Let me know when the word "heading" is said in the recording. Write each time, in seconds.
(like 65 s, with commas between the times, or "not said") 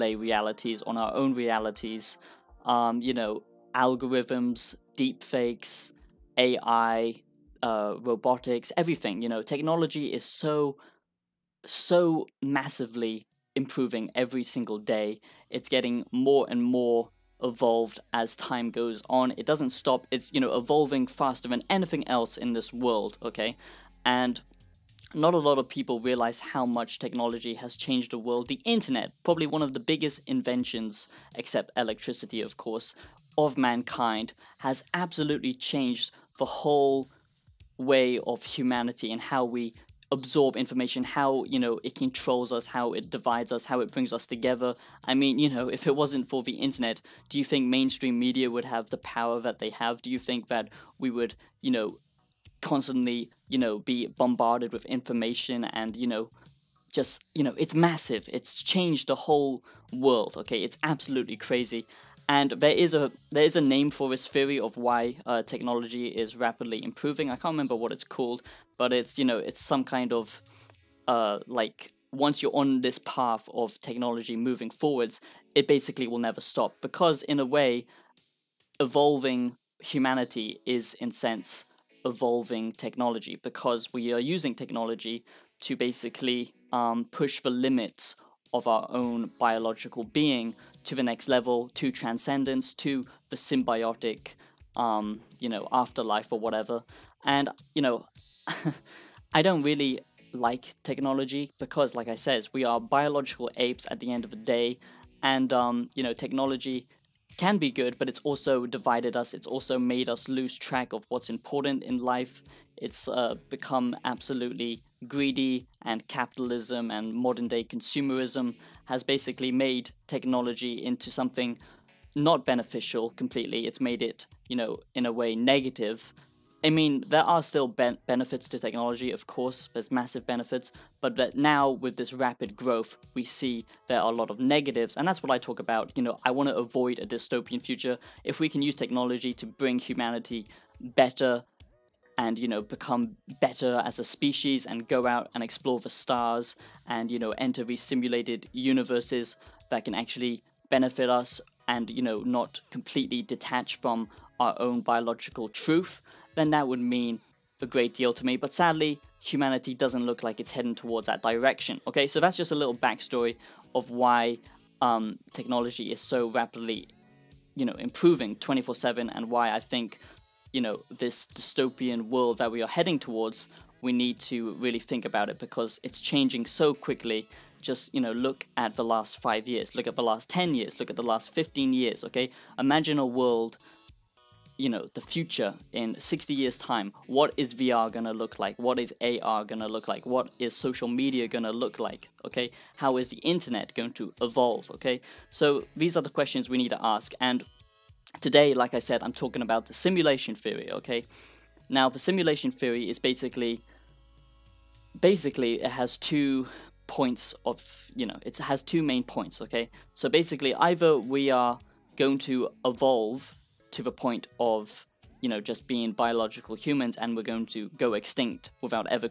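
160 s, 172 s.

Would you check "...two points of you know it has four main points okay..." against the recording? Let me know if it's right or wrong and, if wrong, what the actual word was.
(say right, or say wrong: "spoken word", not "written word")
wrong: "two", not "four".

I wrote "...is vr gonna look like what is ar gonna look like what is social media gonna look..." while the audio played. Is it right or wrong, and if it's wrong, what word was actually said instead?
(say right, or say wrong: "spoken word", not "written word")
right.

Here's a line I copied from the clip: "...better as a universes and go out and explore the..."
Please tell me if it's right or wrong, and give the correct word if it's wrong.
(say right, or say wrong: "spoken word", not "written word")
wrong: "species", not "universes".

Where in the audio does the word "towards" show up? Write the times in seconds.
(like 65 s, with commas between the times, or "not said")
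160 s, 172 s.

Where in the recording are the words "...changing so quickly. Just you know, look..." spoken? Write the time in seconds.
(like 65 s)
176 s.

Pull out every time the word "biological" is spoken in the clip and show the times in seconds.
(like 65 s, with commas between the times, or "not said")
89 s, 102 s, 154 s, 215 s.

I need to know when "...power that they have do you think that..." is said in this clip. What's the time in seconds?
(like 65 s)
48 s.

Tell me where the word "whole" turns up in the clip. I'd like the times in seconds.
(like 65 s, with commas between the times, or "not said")
36 s, 59 s.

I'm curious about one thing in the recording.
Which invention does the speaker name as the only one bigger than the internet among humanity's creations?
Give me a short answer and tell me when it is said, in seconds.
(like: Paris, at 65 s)
Electricity, at 31 s.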